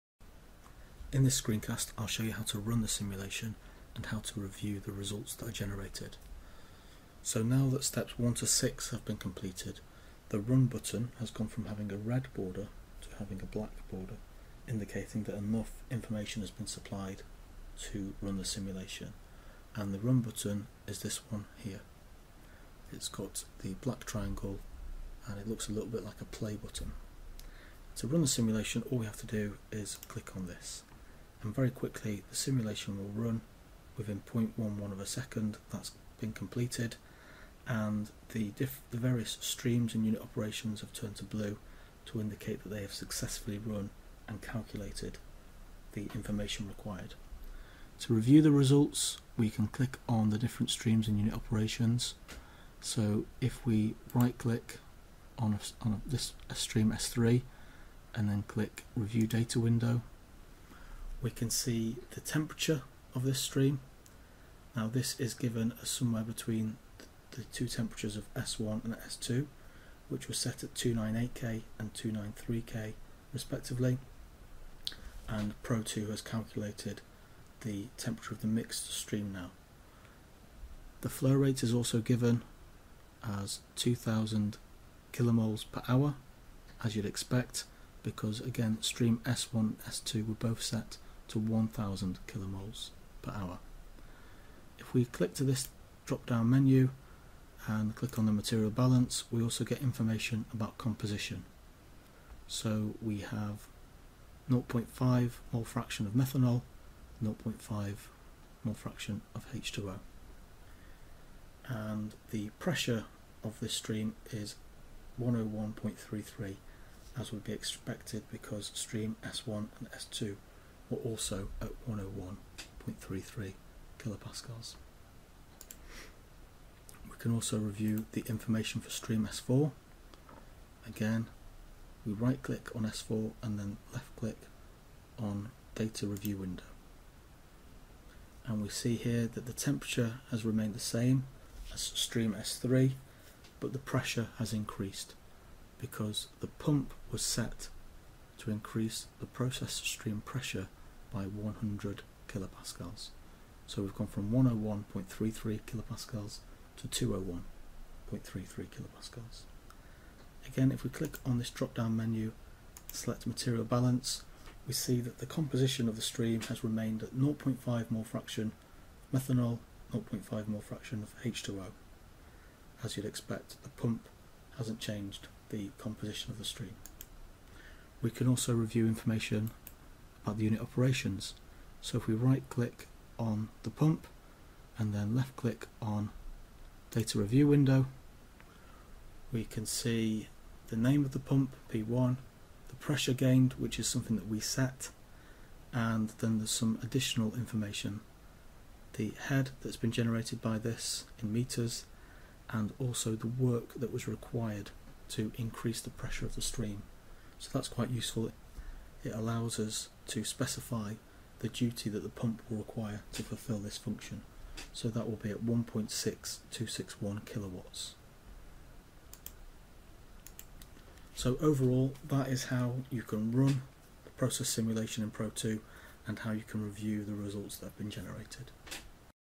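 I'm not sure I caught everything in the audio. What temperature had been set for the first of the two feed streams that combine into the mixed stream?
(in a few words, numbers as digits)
298K.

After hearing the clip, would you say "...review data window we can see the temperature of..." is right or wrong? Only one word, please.
right.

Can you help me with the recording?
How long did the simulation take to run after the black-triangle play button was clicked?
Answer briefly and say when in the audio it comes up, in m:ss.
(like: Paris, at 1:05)
0.11 of a second, at 0:34.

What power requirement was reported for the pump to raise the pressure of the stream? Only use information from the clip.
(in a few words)
1.6261 kilowatts.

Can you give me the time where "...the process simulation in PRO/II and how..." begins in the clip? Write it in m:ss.
3:44.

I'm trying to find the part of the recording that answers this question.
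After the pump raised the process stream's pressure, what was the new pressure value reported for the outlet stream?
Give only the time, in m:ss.
2:36.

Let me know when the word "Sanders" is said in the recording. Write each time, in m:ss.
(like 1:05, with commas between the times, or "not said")
not said.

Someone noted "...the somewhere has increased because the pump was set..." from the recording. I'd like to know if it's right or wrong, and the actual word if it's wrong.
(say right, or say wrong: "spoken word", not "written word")
wrong: "pressure", not "somewhere".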